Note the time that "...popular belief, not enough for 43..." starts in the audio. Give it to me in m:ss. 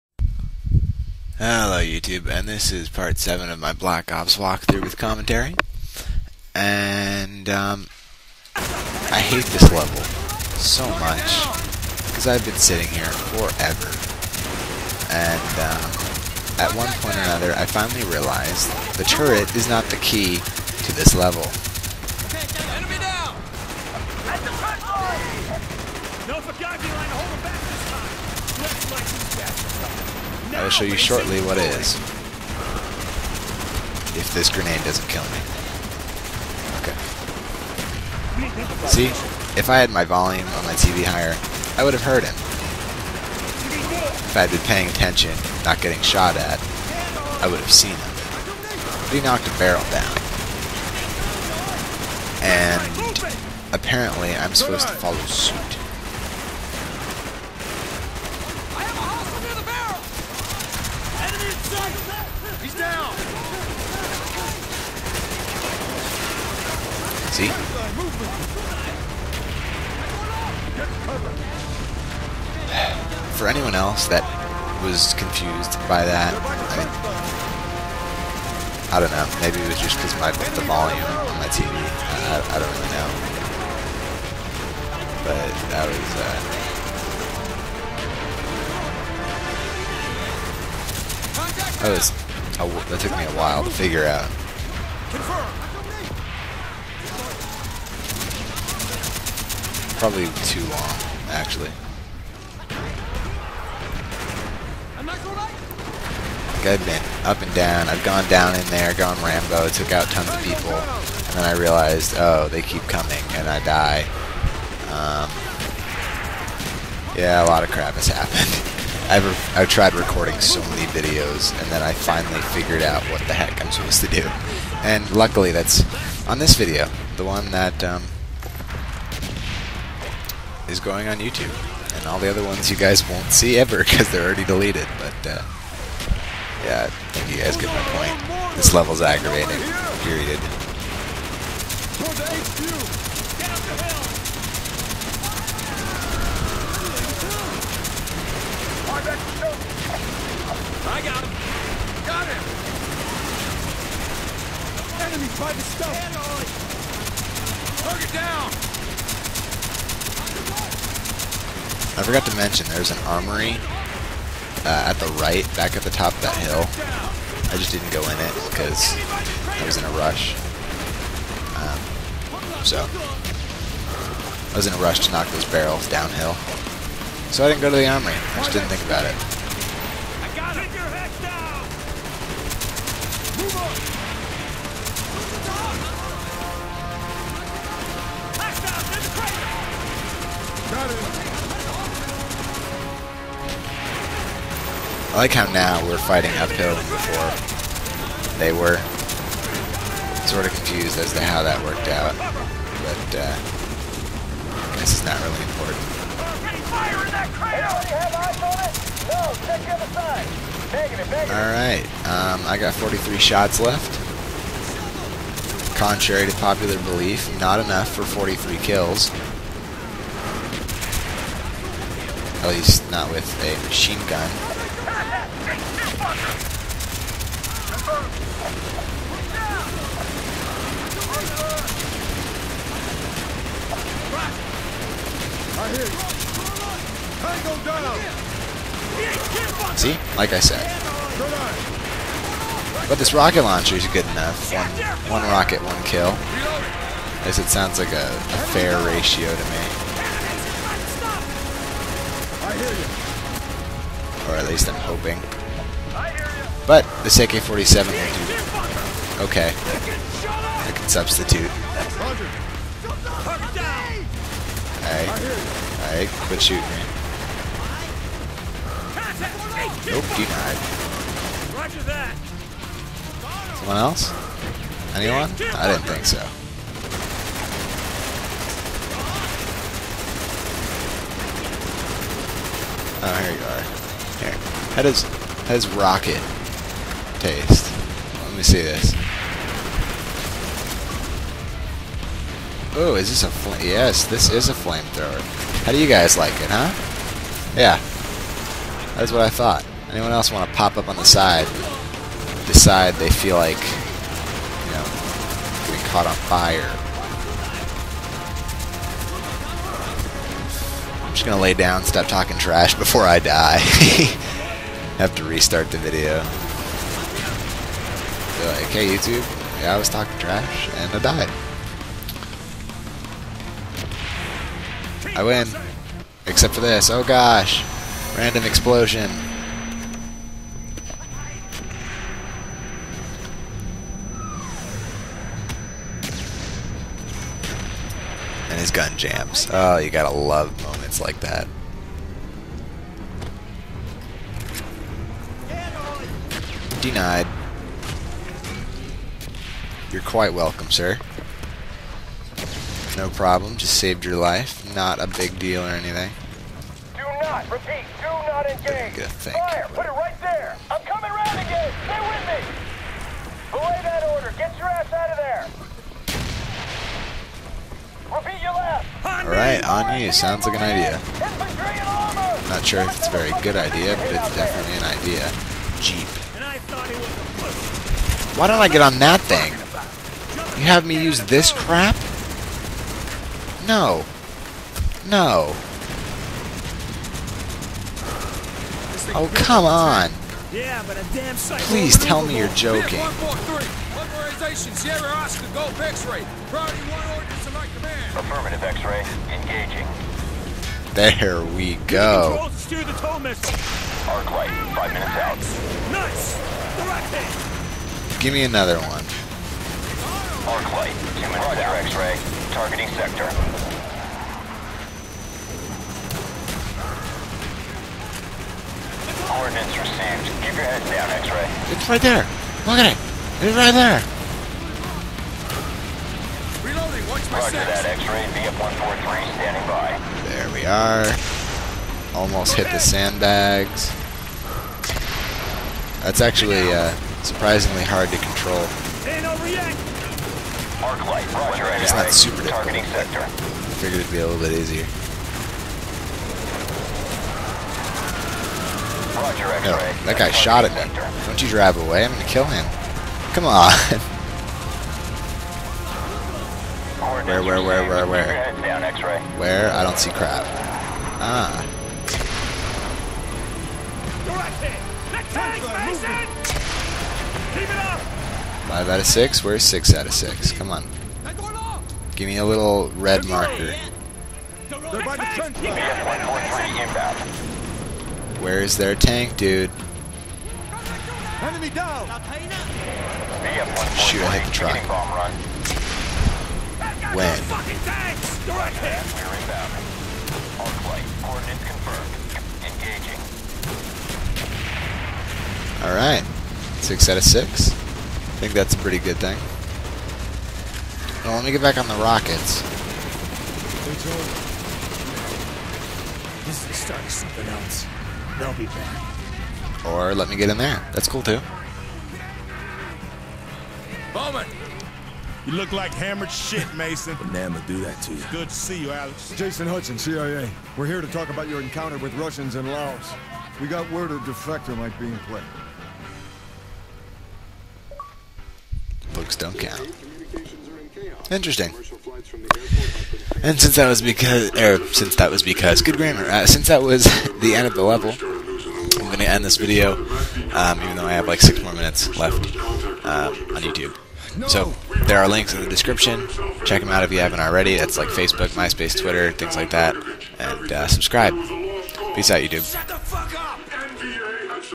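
3:36.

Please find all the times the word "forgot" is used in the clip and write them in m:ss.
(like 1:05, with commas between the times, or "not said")
2:42.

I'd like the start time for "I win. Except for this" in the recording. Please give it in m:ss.
5:25.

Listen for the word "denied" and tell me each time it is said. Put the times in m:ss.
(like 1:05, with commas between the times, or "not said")
4:30, 5:46.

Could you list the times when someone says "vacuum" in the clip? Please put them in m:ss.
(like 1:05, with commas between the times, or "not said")
not said.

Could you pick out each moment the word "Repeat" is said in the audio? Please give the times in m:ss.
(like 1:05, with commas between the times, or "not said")
5:57, 6:08.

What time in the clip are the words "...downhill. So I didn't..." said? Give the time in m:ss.
2:55.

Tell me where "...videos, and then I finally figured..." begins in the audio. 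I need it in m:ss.
2:00.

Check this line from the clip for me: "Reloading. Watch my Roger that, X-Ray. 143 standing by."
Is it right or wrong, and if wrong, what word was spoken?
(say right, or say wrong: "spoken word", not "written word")
right.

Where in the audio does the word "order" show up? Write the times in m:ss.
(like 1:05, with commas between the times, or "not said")
6:04, 6:37.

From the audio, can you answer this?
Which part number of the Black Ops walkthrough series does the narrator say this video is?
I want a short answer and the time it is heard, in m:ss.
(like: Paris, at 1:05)
7, at 0:02.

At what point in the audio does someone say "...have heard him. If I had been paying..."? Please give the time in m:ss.
0:41.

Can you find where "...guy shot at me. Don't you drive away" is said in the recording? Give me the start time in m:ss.
7:30.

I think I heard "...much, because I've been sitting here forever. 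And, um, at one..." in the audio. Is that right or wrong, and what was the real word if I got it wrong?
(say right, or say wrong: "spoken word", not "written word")
right.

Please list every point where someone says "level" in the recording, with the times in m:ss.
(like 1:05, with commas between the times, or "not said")
0:09, 0:21, 2:18, 8:57.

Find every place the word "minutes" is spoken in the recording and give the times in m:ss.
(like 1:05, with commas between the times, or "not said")
6:44, 6:51, 9:01.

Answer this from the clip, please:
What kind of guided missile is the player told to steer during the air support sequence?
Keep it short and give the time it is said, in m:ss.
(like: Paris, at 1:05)
tow missile, at 6:42.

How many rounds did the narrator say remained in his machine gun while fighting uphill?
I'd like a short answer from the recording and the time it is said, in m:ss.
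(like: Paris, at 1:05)
43, at 3:32.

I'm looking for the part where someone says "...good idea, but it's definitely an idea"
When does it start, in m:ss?
6:13.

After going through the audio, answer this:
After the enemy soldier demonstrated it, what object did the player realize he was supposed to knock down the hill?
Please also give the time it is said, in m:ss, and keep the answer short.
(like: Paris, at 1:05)
barrel, at 0:49.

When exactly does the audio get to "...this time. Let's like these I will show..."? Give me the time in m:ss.
0:27.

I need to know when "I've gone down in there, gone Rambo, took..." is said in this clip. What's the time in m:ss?
1:47.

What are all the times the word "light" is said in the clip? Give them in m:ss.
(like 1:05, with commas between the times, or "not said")
6:44, 6:50, 7:21.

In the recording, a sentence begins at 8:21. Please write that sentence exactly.
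Well, let me get back on the rockets.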